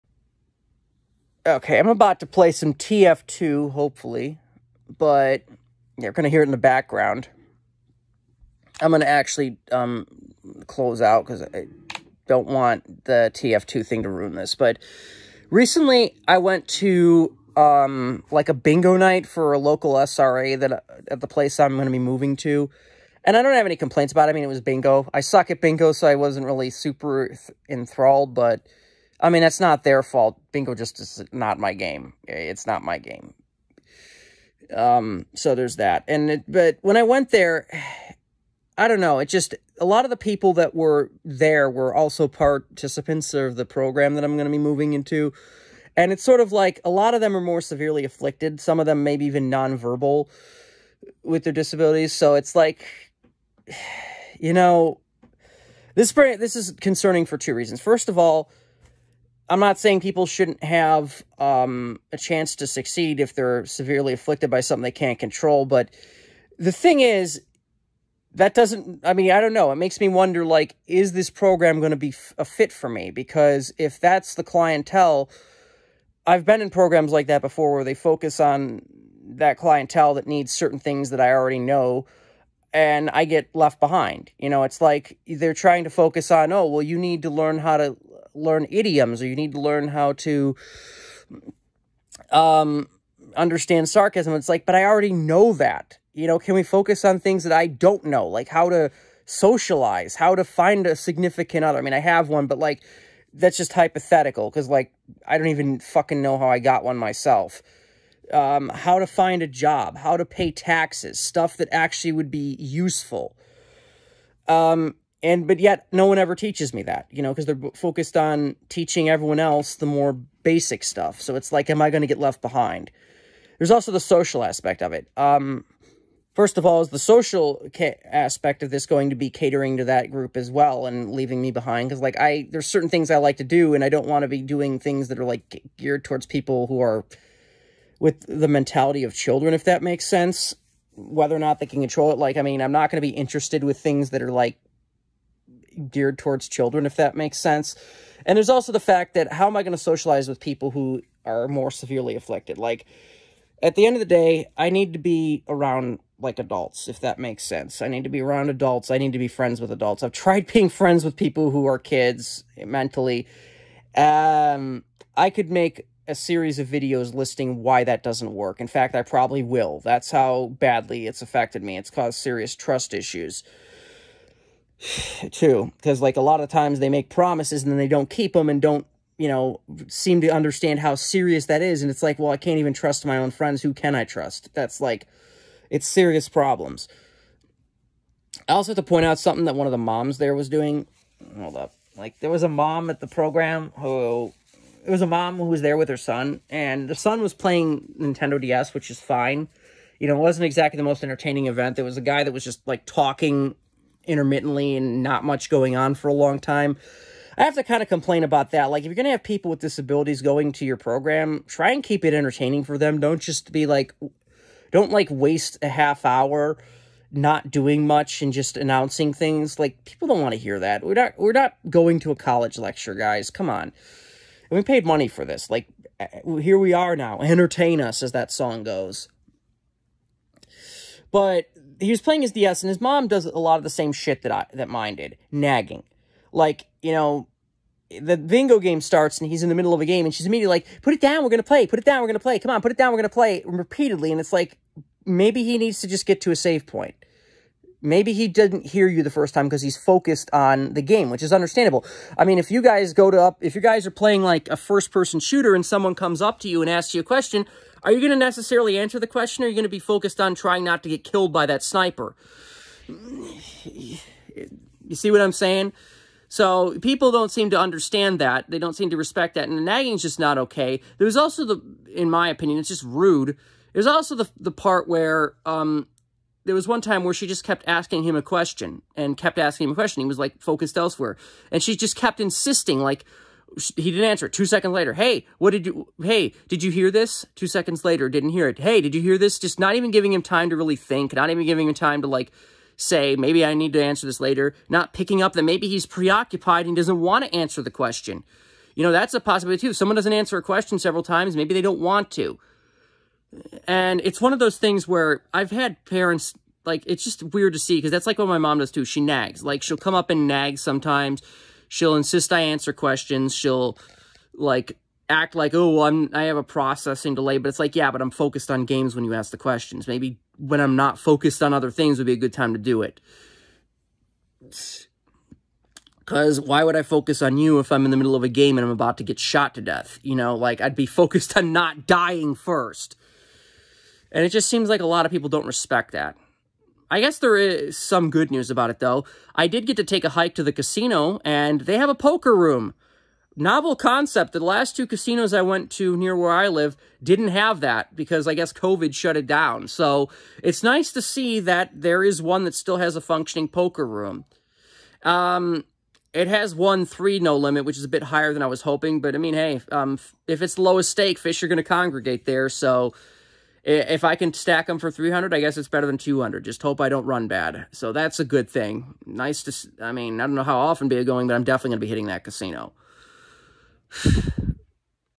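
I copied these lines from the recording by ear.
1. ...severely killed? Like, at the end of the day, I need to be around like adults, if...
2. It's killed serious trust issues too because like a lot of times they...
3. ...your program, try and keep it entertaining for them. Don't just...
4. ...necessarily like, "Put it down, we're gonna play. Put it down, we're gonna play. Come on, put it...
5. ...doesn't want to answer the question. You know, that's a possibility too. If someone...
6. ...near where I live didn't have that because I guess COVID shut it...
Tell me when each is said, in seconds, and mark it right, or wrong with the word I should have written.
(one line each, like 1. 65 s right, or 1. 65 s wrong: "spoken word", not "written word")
1. 151 s wrong: "afflicted", not "killed"
2. 171 s wrong: "caused", not "killed"
3. 210 s right
4. 240 s wrong: "immediately", not "necessarily"
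5. 296 s right
6. 345 s right.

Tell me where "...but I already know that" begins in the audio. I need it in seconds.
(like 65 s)
94 s.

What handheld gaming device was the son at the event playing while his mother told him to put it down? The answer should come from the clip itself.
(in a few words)
Nintendo DS.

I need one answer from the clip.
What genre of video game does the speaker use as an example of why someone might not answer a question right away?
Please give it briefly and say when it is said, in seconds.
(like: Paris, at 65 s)
First person shooter, at 254 s.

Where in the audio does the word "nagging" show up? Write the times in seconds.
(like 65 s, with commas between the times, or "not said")
235 s, 269 s.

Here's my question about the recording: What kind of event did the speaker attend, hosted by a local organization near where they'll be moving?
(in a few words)
Bingo night.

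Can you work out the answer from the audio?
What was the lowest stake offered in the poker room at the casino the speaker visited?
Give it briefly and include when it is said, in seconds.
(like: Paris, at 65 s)
1/3 no limit, at 356 s.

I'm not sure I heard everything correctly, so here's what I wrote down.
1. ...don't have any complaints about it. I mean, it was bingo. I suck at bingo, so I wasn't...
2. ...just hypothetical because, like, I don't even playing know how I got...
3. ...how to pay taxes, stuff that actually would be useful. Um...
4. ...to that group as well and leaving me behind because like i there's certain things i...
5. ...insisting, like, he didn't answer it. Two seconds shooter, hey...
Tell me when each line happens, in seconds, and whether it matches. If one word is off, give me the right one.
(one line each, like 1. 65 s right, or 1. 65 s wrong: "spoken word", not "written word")
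1. 23 s right
2. 103 s wrong: "fucking", not "playing"
3. 109 s right
4. 129 s right
5. 282 s wrong: "later", not "shooter".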